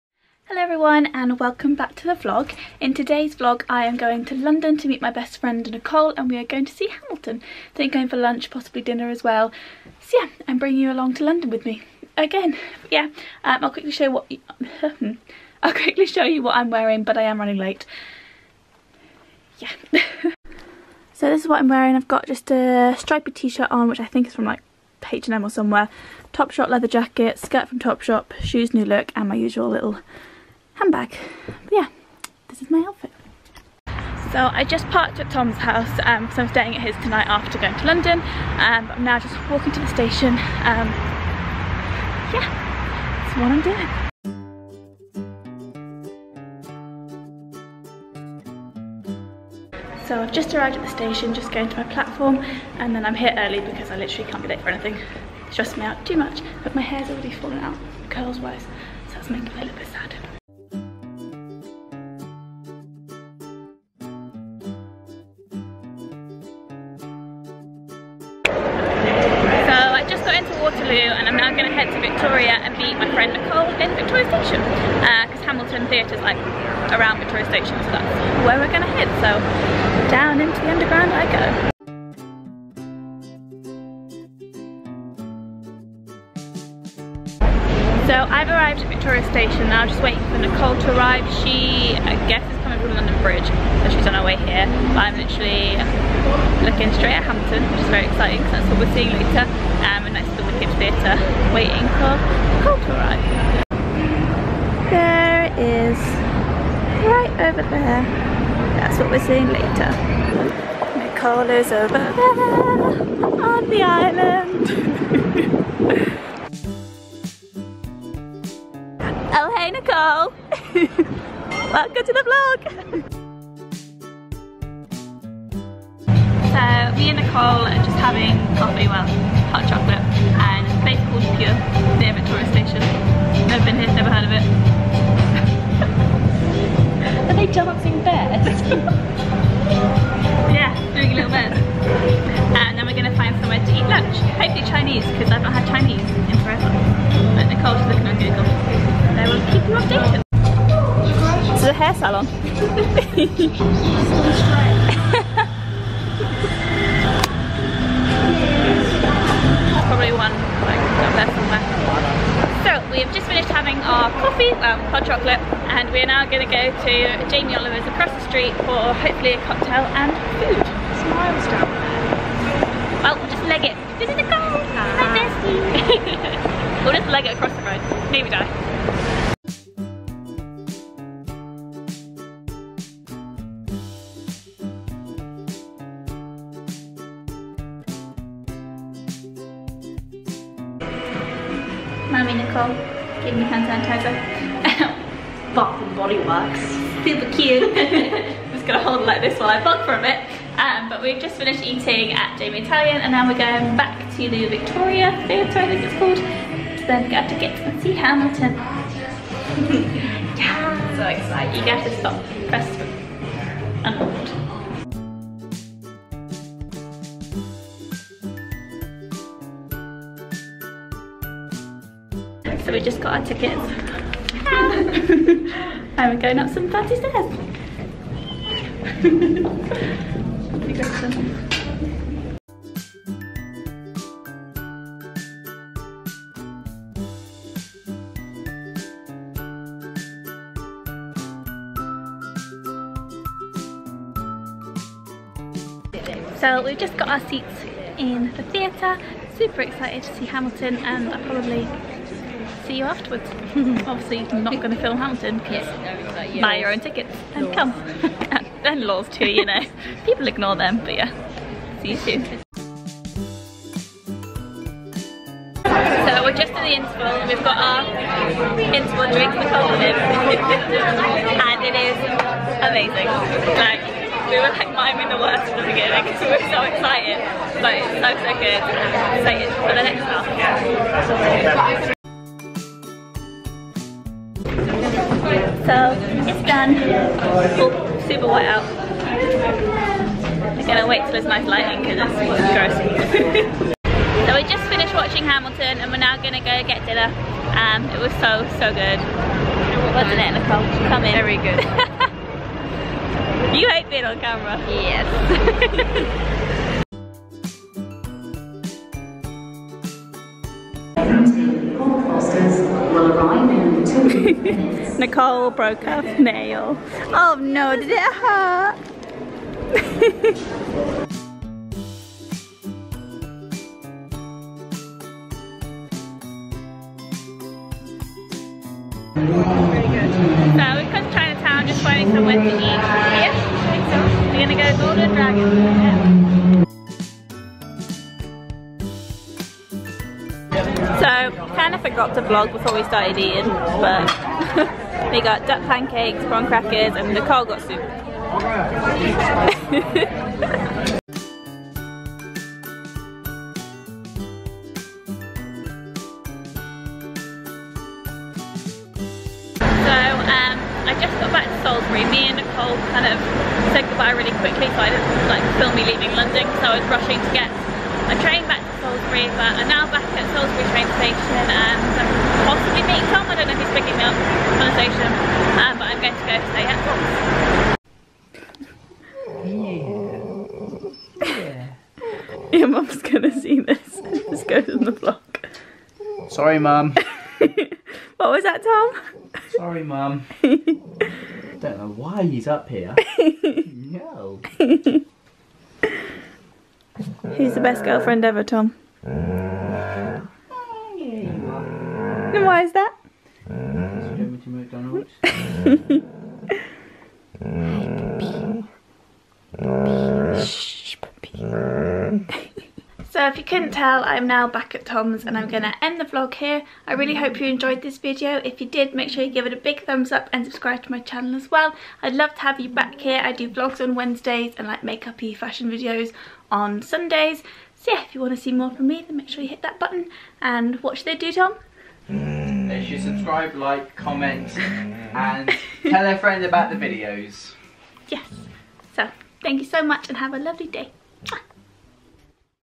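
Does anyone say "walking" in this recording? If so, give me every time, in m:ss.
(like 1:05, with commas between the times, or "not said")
0:39.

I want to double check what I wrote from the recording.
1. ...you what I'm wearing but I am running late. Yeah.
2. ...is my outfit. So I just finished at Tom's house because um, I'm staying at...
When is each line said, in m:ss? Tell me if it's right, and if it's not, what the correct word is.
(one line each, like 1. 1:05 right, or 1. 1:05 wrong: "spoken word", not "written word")
1. 0:16 right
2. 0:32 wrong: "parked", not "finished".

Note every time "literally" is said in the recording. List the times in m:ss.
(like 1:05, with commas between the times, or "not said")
0:53, 1:35.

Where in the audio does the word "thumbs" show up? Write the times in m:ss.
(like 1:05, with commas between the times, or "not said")
6:59.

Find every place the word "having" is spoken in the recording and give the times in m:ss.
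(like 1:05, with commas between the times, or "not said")
2:07, 2:43.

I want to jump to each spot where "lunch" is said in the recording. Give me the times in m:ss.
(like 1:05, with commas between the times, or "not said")
0:08, 2:23.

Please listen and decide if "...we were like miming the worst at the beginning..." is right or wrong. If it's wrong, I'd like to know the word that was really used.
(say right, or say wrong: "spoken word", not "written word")
right.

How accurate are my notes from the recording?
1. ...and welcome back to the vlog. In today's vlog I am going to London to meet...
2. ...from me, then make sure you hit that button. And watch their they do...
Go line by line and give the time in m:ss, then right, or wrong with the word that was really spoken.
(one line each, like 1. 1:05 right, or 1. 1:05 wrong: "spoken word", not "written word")
1. 0:01 right
2. 7:08 right.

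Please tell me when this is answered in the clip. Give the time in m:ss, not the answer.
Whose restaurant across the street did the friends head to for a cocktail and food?
2:47.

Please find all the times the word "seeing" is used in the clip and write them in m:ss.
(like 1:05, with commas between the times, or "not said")
1:38, 1:49.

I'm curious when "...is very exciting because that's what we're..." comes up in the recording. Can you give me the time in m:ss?
1:37.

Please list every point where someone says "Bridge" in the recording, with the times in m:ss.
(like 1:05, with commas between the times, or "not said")
1:33.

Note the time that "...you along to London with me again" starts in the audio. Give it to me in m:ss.
0:10.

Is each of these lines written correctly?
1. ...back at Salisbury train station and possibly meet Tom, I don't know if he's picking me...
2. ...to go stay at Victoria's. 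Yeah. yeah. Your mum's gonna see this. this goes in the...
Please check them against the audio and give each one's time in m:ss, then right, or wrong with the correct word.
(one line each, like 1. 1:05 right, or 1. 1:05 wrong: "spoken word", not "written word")
1. 6:09 right
2. 6:20 wrong: "Tom", not "Victoria".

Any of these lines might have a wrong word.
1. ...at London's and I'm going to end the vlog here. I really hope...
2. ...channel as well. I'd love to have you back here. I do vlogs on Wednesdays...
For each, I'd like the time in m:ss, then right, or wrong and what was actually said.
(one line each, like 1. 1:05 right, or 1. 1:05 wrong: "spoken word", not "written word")
1. 6:54 wrong: "Tom", not "London"
2. 7:00 right.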